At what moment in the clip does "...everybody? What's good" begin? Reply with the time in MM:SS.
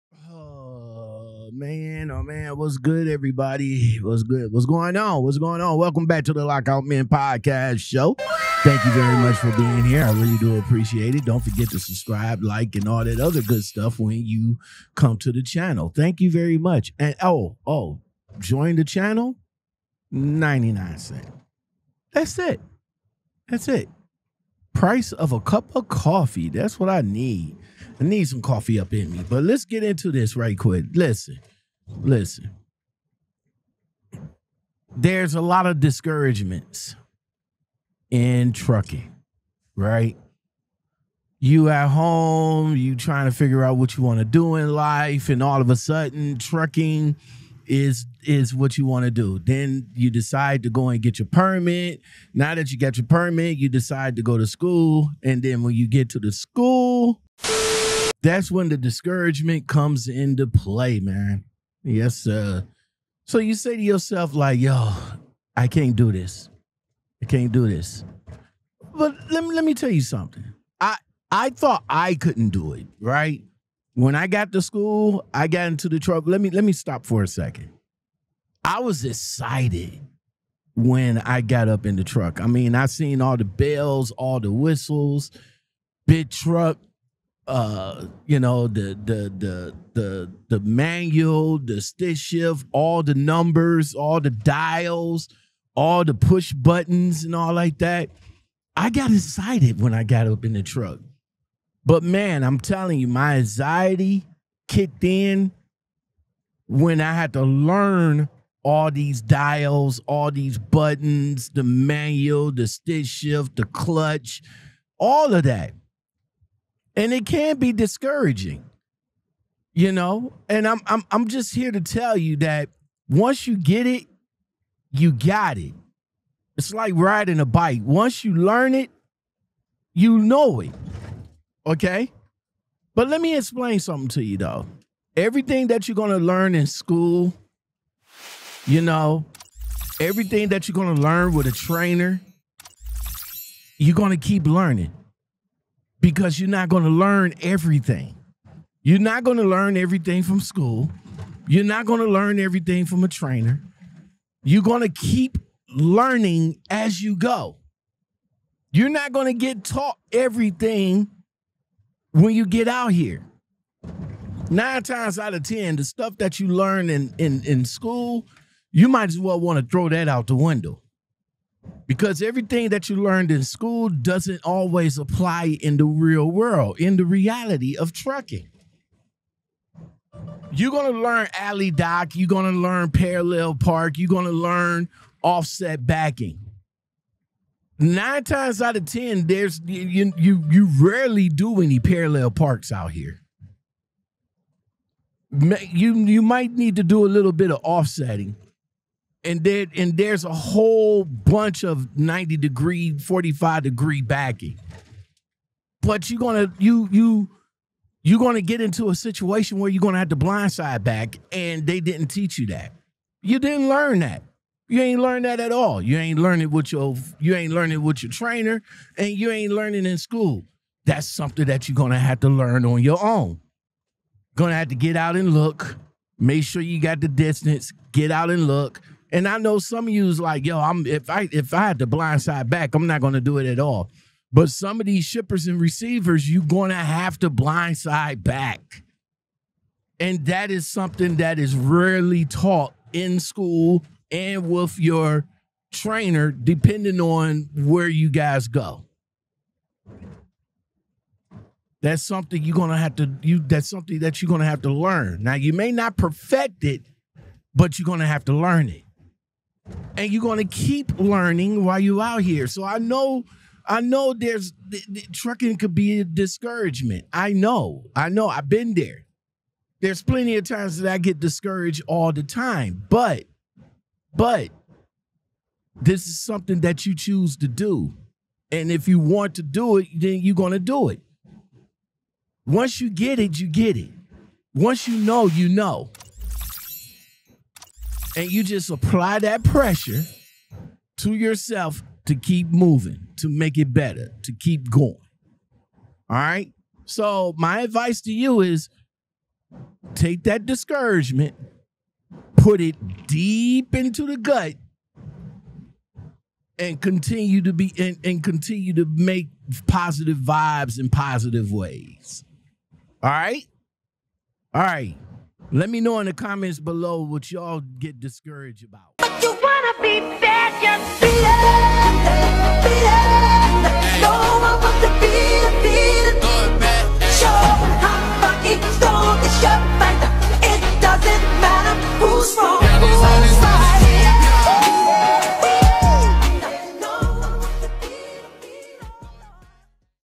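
00:03.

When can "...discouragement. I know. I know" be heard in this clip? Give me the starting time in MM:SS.
04:26.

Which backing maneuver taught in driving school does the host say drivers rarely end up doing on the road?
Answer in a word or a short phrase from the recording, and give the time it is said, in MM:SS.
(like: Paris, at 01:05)
parallel park, at 03:11.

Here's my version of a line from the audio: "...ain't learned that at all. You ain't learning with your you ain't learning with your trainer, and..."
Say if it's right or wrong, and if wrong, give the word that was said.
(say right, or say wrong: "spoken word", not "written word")
right.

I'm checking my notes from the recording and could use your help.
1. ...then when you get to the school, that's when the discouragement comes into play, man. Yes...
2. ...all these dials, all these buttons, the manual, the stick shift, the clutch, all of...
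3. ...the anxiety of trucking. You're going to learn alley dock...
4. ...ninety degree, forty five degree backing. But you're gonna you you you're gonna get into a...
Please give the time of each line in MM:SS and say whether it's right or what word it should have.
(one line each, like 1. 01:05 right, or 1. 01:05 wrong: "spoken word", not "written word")
1. 00:55 right
2. 01:48 right
3. 02:56 wrong: "reality", not "anxiety"
4. 03:21 right.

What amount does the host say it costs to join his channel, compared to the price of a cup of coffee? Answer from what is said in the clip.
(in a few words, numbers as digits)
99 cents.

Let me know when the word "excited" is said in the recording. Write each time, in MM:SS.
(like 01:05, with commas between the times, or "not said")
01:19, 01:39.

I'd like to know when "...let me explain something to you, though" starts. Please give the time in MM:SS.
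02:13.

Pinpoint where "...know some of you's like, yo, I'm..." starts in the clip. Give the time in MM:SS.
03:49.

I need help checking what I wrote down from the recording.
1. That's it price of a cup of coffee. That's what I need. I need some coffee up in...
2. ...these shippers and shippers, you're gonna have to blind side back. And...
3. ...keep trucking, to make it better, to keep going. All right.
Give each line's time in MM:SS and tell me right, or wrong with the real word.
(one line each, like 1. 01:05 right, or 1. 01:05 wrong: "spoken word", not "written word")
1. 00:23 right
2. 03:54 wrong: "receivers", not "shippers"
3. 04:52 wrong: "moving", not "trucking".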